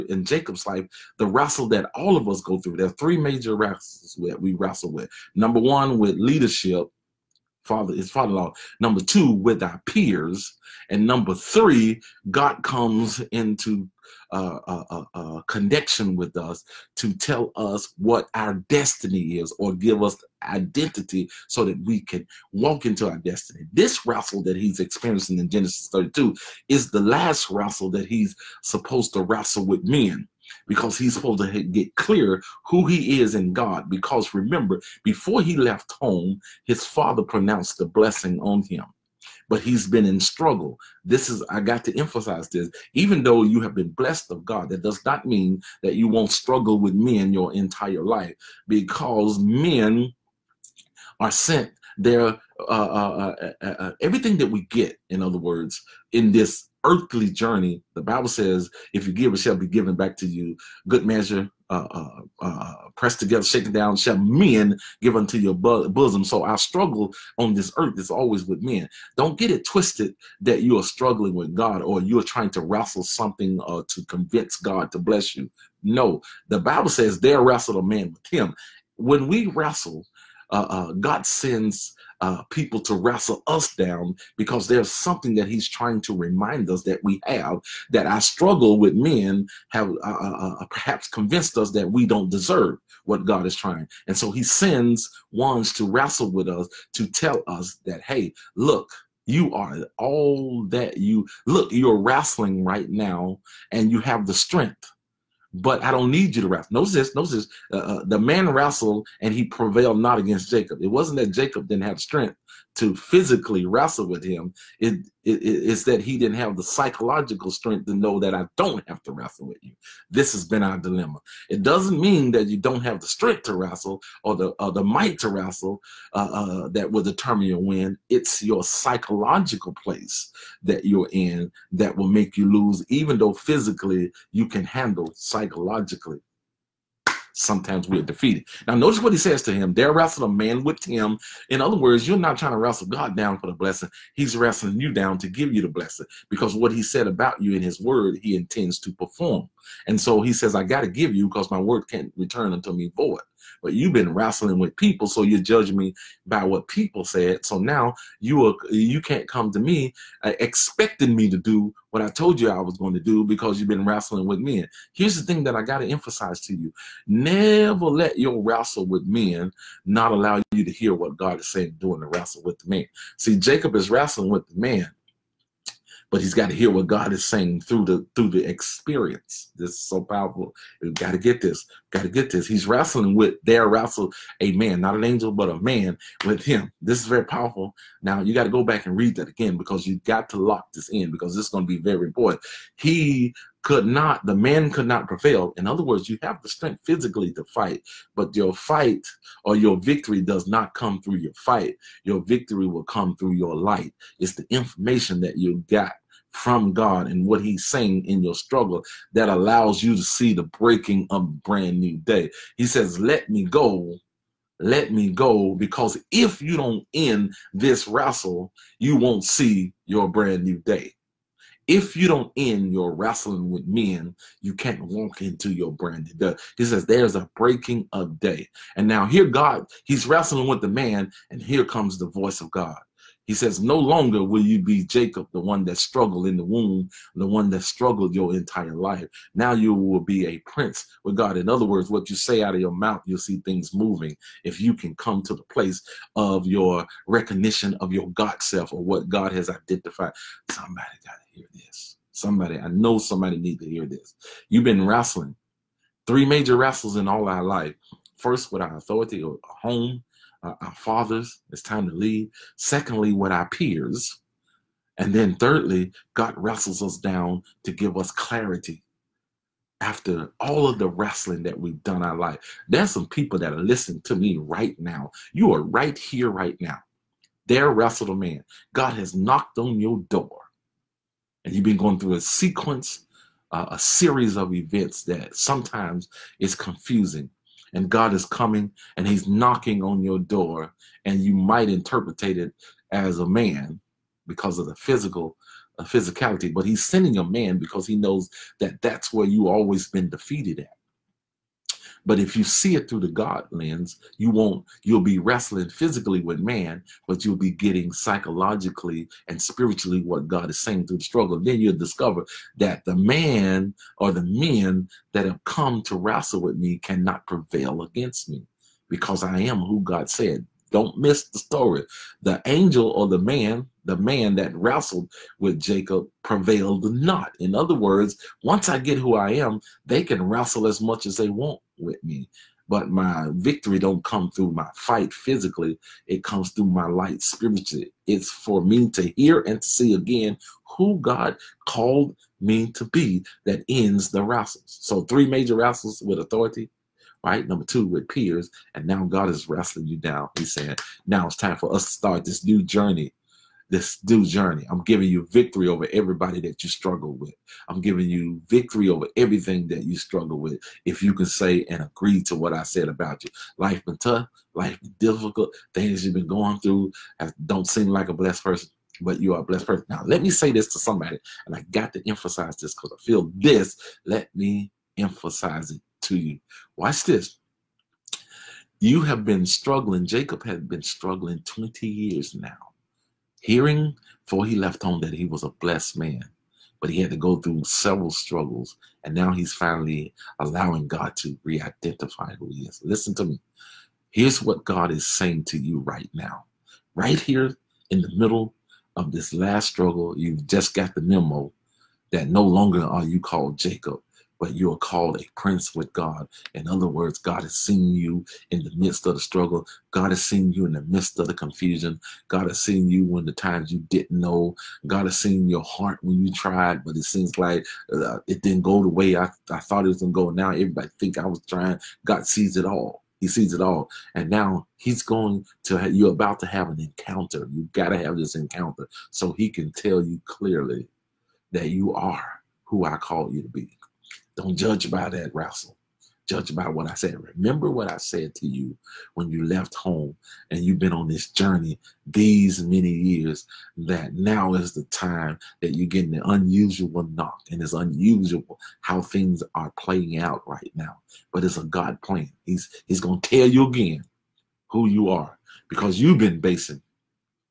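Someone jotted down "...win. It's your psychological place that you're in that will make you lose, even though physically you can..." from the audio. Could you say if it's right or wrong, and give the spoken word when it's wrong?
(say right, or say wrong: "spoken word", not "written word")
right.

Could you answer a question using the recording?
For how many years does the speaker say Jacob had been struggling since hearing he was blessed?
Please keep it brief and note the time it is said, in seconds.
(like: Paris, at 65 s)
20, at 381 s.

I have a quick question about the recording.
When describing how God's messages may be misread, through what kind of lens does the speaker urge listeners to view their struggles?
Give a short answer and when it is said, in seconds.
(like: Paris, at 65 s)
the God lens, at 303 s.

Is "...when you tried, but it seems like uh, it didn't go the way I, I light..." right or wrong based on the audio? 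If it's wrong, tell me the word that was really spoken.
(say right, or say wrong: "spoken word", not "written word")
wrong: "thought", not "light".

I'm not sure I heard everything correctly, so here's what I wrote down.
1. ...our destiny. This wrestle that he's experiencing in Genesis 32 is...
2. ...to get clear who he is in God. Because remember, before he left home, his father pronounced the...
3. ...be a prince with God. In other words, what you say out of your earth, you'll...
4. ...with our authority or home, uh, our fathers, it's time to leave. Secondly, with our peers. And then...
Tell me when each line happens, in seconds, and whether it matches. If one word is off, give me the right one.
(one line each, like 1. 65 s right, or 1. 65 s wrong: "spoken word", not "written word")
1. 23 s right
2. 31 s right
3. 240 s wrong: "mouth", not "earth"
4. 258 s right.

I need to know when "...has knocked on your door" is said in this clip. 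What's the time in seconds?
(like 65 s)
278 s.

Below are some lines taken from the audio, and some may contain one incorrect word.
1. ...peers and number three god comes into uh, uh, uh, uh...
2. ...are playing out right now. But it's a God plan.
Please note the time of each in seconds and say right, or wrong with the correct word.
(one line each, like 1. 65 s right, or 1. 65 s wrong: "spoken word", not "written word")
1. 9 s right
2. 449 s right.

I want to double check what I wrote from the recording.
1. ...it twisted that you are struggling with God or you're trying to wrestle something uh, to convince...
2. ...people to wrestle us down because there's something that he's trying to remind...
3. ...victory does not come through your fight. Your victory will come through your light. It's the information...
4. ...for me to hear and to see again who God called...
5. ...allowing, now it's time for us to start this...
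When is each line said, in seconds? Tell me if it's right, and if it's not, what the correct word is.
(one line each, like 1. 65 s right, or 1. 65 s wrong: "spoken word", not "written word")
1. 69 s right
2. 82 s right
3. 199 s right
4. 338 s right
5. 350 s wrong: "saying", not "allowing".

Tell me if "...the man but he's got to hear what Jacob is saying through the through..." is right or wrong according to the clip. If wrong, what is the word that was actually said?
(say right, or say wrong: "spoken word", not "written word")
wrong: "God", not "Jacob".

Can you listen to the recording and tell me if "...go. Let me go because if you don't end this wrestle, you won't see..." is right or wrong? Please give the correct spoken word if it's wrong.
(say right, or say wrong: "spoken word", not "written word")
right.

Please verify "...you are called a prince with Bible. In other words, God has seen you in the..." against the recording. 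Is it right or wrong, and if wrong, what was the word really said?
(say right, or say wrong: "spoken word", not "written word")
wrong: "God", not "Bible".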